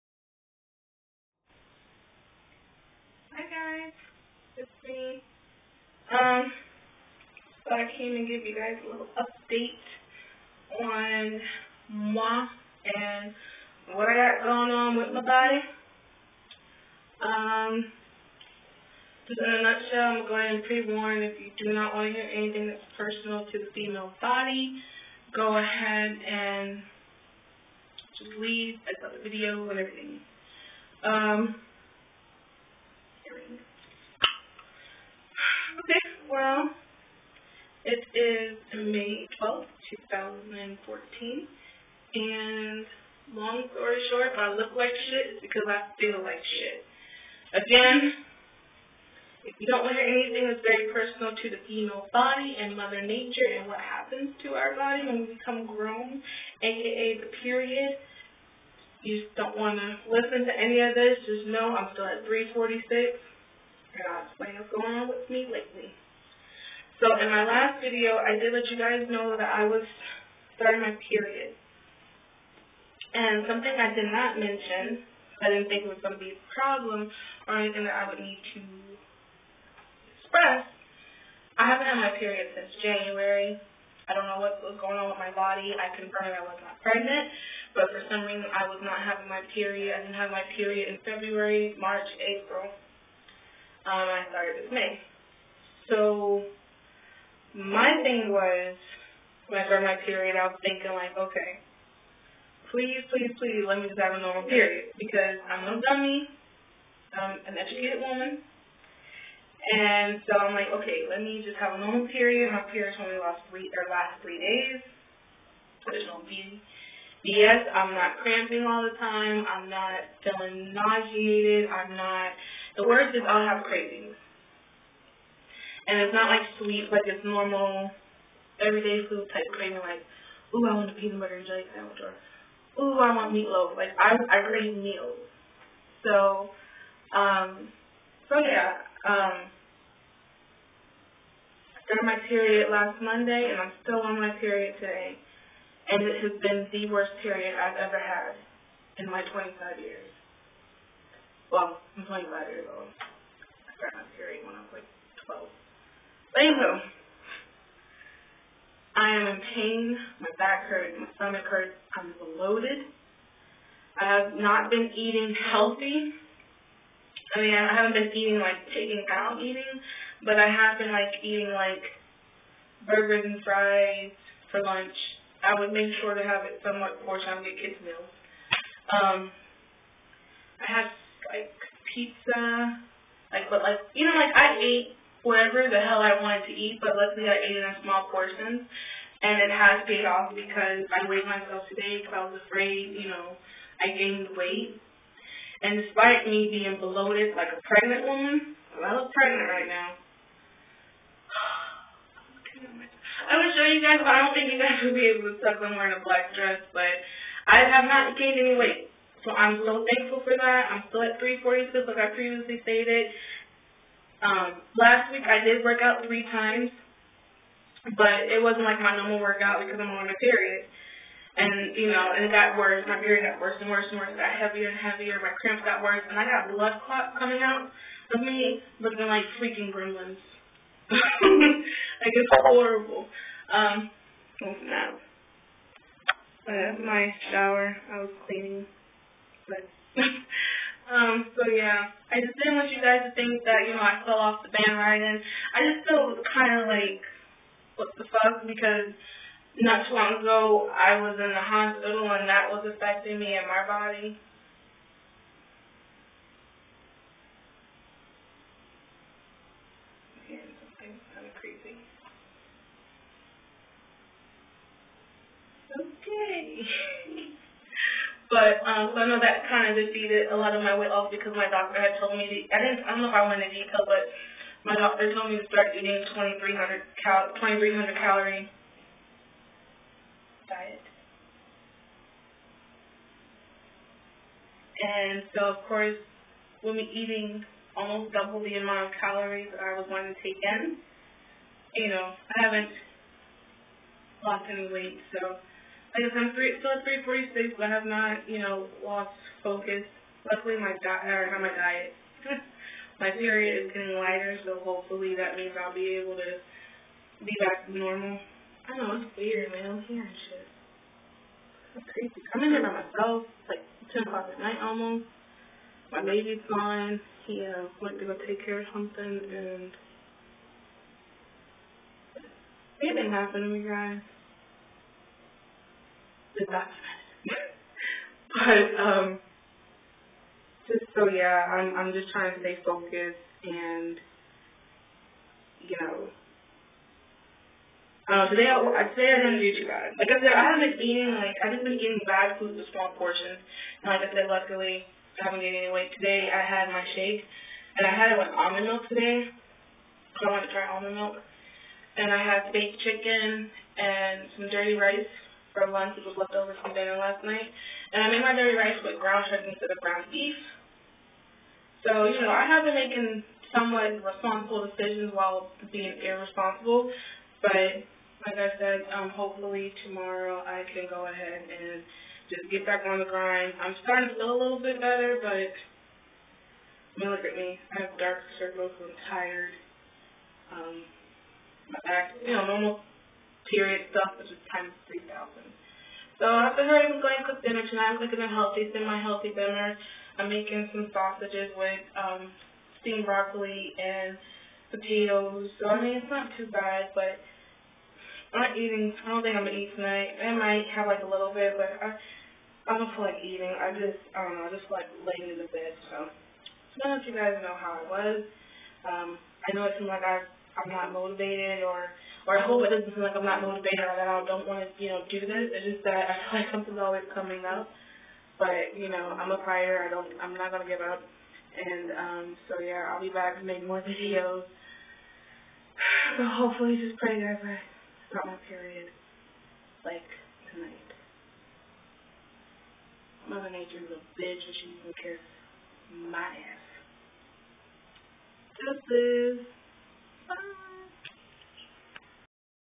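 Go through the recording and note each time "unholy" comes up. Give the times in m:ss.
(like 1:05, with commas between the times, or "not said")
not said.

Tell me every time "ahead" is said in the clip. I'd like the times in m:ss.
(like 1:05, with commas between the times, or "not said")
0:25, 6:11.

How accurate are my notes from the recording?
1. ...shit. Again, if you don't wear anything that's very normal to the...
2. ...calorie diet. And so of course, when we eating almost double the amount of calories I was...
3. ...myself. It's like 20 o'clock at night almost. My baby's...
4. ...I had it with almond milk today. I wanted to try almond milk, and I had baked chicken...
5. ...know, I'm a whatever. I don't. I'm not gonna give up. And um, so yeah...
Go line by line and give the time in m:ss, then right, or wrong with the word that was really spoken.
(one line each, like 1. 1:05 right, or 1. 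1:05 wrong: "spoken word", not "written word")
1. 0:46 wrong: "personal", not "normal"
2. 4:37 right
3. 5:12 wrong: "10", not "20"
4. 5:47 right
5. 6:58 wrong: "fighter", not "whatever".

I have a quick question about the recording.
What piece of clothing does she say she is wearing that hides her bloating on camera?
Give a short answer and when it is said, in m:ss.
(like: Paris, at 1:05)
Black dress, at 3:26.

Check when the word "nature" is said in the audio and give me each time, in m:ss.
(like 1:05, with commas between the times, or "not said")
0:53, 7:13.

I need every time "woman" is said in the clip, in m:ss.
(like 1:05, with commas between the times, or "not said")
1:48, 3:18.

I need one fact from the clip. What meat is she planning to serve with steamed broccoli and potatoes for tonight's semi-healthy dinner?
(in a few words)
Sausages.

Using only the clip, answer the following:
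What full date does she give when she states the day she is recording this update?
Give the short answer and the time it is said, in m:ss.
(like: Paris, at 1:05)
May 12th, 2014, at 0:38.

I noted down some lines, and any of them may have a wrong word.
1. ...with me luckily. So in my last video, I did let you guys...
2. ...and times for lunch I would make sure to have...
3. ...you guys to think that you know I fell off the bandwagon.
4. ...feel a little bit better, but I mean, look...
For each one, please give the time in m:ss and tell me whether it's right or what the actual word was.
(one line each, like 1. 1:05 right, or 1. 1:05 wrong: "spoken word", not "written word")
1. 1:05 wrong: "lately", not "luckily"
2. 2:53 wrong: "fries", not "times"
3. 4:02 right
4. 6:14 right.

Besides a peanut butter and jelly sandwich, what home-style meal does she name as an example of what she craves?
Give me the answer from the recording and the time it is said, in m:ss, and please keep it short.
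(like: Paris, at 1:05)
Meatloaf, at 2:13.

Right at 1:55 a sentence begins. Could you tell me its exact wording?
So there's no B Yes, I'm not cramping all the time.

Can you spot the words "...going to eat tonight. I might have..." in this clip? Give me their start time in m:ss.
6:39.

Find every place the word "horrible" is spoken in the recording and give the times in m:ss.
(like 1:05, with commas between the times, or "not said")
3:52.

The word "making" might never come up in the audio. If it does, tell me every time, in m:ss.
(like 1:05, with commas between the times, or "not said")
6:02, 6:30.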